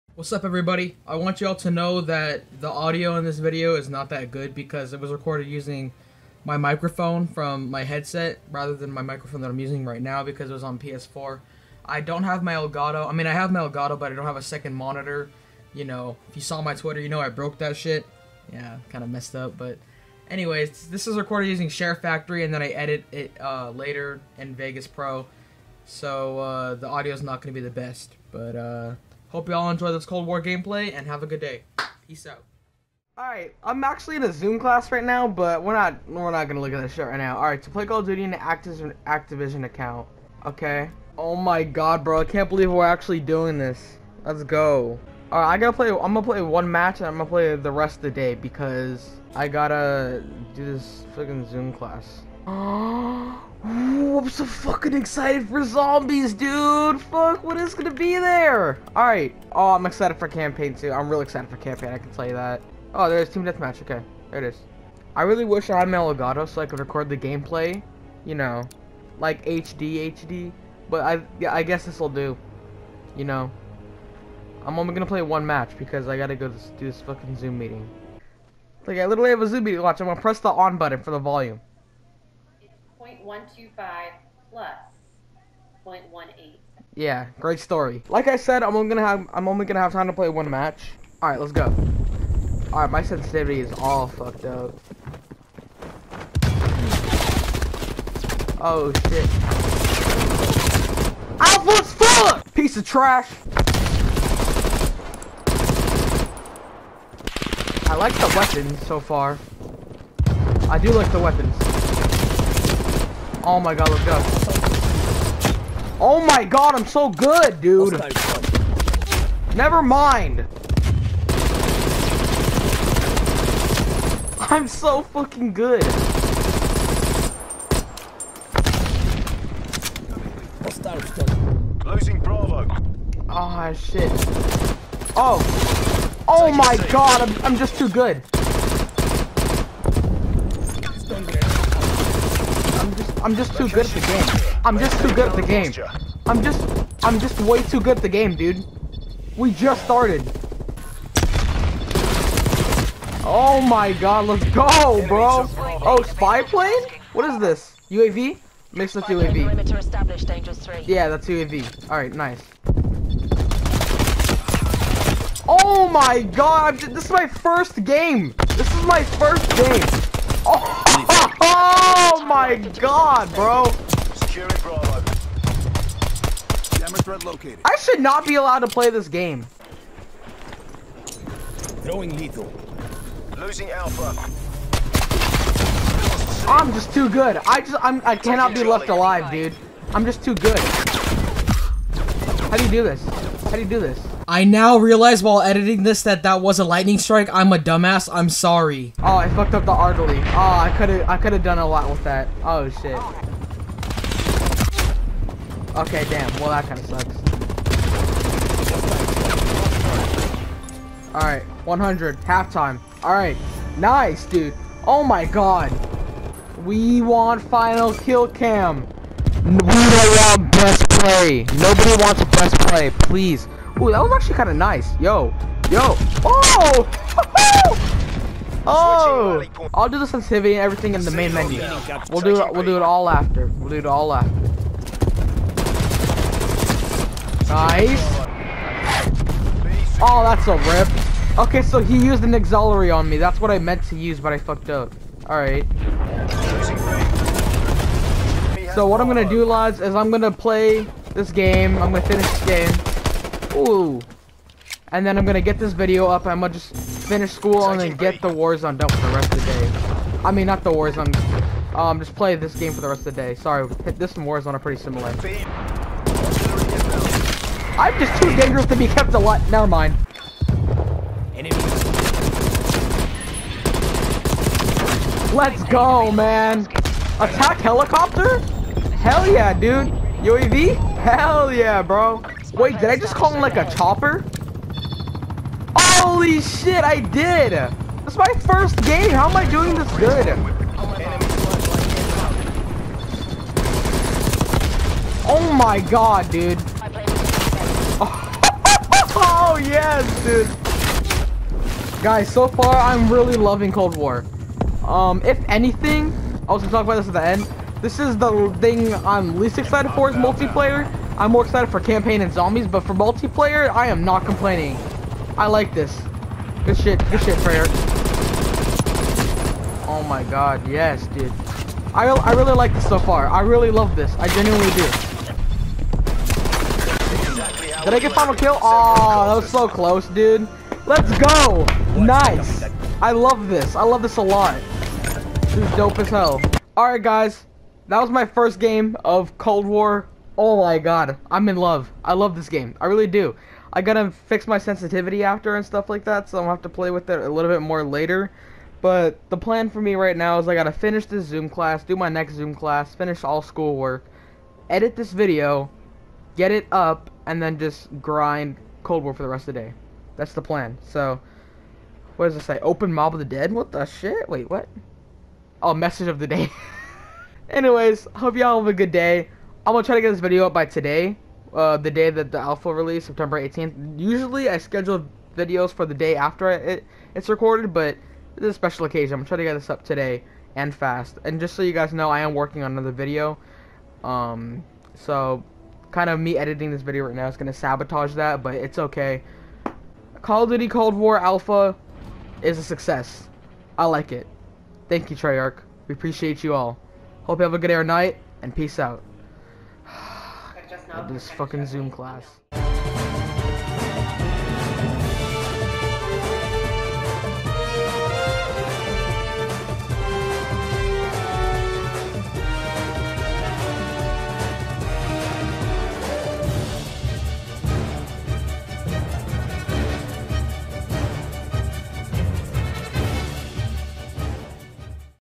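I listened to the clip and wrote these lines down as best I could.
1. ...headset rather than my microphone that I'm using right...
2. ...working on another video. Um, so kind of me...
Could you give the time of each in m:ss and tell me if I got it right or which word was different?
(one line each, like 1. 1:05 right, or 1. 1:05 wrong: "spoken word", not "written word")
1. 0:07 right
2. 6:22 right.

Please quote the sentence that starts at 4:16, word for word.
I'm gonna just finish school and then get the Warzone done for the rest of the day.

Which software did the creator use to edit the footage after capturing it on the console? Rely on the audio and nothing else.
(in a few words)
Vegas Pro.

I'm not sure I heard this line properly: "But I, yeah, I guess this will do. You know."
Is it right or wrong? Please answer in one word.
right.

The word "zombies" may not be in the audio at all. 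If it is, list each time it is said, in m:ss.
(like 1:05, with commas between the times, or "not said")
0:55, 5:12.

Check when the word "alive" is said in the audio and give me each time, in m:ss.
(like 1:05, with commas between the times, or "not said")
3:08, 4:29.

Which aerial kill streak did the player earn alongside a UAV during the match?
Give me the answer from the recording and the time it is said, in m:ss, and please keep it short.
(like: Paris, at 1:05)
Attack helicopter, at 4:37.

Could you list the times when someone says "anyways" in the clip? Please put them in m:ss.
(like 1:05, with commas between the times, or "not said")
0:20, 6:07.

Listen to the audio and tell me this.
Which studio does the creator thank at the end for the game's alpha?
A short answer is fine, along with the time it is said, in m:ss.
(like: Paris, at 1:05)
Treyarch, at 6:35.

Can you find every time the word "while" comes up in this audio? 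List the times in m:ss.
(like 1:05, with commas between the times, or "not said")
3:15.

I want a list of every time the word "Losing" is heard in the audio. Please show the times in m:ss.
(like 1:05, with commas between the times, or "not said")
2:11, 3:03.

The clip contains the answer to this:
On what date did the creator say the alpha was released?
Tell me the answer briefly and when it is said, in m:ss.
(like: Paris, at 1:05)
September 18th, at 6:13.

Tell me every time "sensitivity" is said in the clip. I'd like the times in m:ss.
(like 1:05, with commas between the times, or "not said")
1:33, 3:50, 5:44.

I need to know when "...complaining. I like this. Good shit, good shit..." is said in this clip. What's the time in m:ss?
5:14.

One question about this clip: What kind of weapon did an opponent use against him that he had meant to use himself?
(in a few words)
auxiliary.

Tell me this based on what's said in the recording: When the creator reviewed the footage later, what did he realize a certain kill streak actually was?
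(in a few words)
lightning strike.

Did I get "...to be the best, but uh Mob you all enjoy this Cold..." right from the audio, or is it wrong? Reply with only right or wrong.
wrong.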